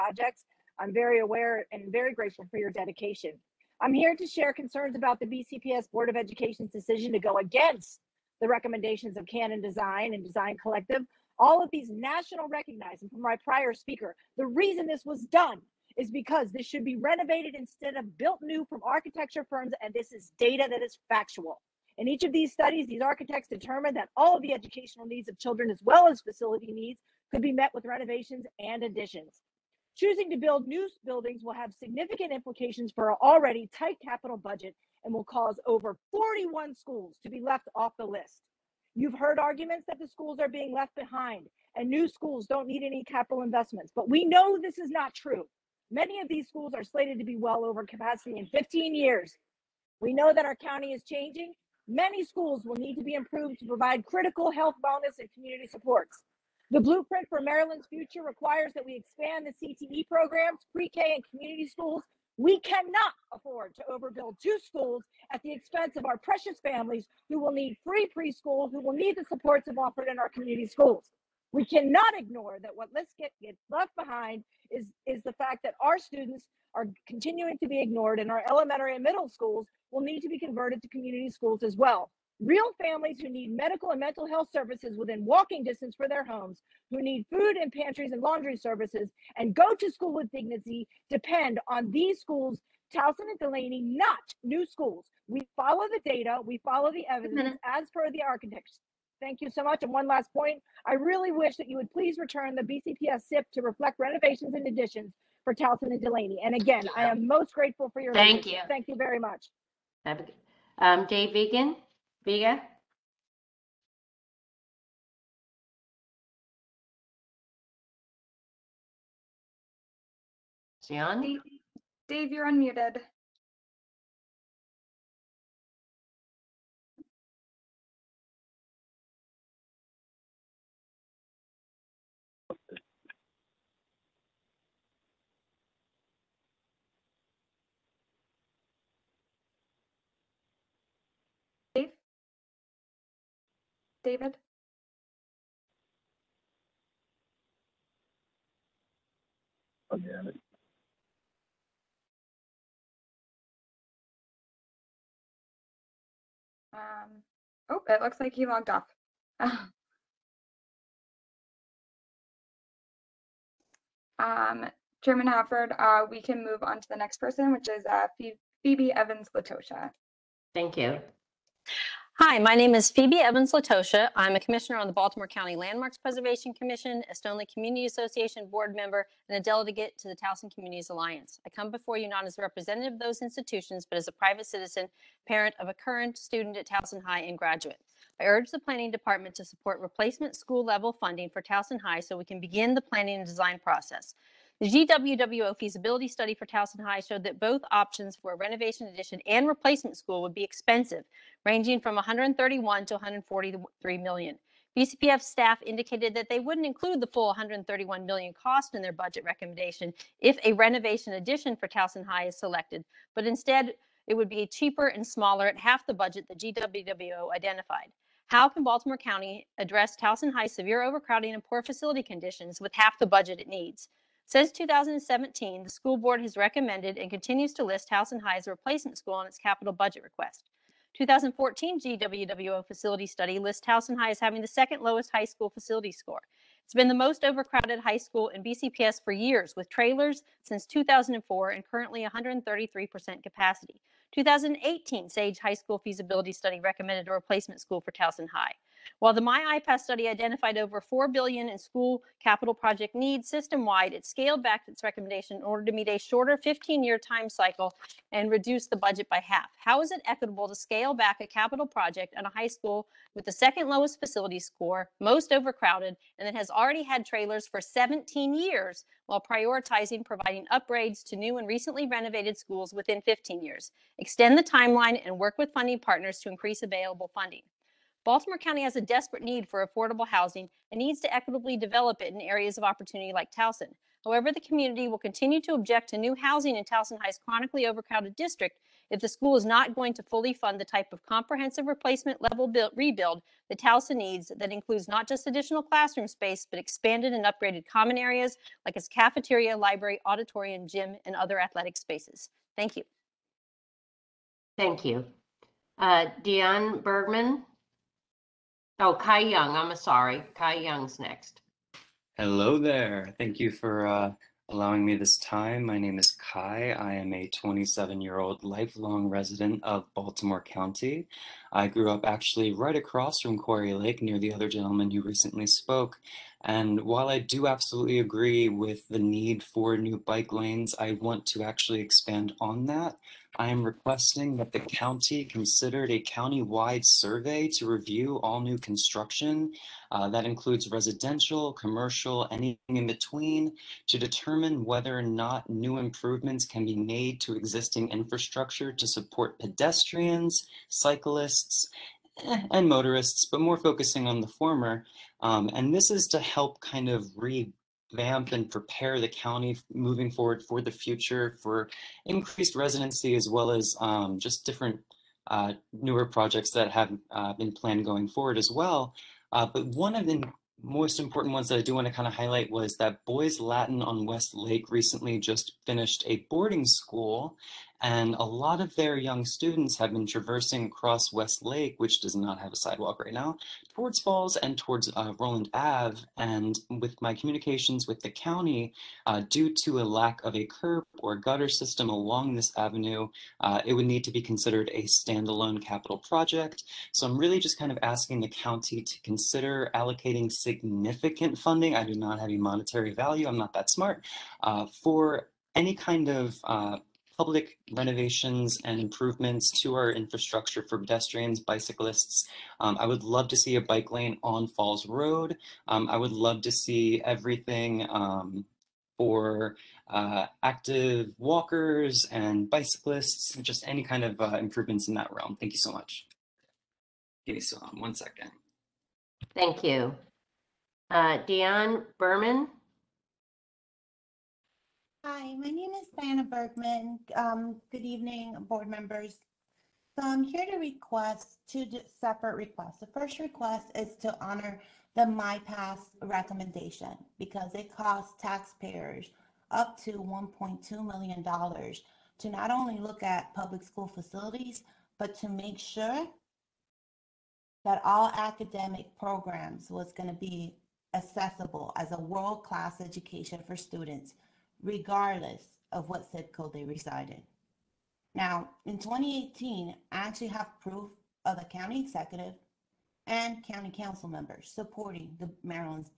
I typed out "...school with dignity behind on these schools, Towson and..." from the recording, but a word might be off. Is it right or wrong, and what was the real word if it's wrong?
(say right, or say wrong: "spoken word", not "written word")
wrong: "depend", not "behind".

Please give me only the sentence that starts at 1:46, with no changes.
And again, I am most grateful for your.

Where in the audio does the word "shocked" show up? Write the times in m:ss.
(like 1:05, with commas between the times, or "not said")
not said.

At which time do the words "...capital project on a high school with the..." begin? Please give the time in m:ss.
4:21.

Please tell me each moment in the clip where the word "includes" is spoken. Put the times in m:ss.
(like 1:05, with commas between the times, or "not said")
3:26, 4:54, 5:40.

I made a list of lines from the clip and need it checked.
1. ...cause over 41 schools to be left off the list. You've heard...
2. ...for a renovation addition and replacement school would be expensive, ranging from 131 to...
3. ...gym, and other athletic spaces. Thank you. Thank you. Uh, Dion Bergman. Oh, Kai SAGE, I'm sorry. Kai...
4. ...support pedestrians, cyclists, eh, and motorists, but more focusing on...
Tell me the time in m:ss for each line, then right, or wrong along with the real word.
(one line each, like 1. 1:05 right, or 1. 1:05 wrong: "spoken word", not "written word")
1. 0:35 right
2. 3:18 right
3. 5:00 wrong: "Young", not "SAGE"
4. 5:48 right.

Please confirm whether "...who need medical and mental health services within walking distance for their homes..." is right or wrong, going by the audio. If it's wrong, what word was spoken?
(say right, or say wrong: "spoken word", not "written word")
right.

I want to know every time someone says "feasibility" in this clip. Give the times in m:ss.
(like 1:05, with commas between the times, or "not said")
3:15, 4:05.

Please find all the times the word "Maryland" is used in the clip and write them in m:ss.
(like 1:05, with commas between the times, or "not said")
0:57, 7:55.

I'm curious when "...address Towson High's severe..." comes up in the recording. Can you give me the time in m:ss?
3:39.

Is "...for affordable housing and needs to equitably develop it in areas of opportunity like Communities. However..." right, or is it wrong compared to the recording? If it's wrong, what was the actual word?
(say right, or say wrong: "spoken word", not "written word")
wrong: "Towson", not "Communities".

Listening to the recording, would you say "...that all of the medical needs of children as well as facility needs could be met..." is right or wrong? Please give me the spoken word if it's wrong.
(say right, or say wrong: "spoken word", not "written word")
wrong: "educational", not "medical".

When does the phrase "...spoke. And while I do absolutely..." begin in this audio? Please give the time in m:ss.
5:25.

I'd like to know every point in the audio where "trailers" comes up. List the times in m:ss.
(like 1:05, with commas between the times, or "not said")
3:59, 4:27.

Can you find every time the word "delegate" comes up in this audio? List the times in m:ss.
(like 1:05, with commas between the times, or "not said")
2:59.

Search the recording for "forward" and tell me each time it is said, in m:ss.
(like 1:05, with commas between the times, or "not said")
6:00, 6:08.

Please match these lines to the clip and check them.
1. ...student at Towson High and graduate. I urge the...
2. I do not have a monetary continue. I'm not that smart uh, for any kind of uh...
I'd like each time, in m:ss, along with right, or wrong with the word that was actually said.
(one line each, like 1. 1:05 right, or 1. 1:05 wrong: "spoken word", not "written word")
1. 3:06 right
2. 6:41 wrong: "value", not "continue".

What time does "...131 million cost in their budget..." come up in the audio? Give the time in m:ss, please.
3:27.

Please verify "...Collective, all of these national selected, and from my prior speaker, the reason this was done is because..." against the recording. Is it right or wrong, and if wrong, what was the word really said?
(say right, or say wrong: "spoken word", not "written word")
wrong: "recognized", not "selected".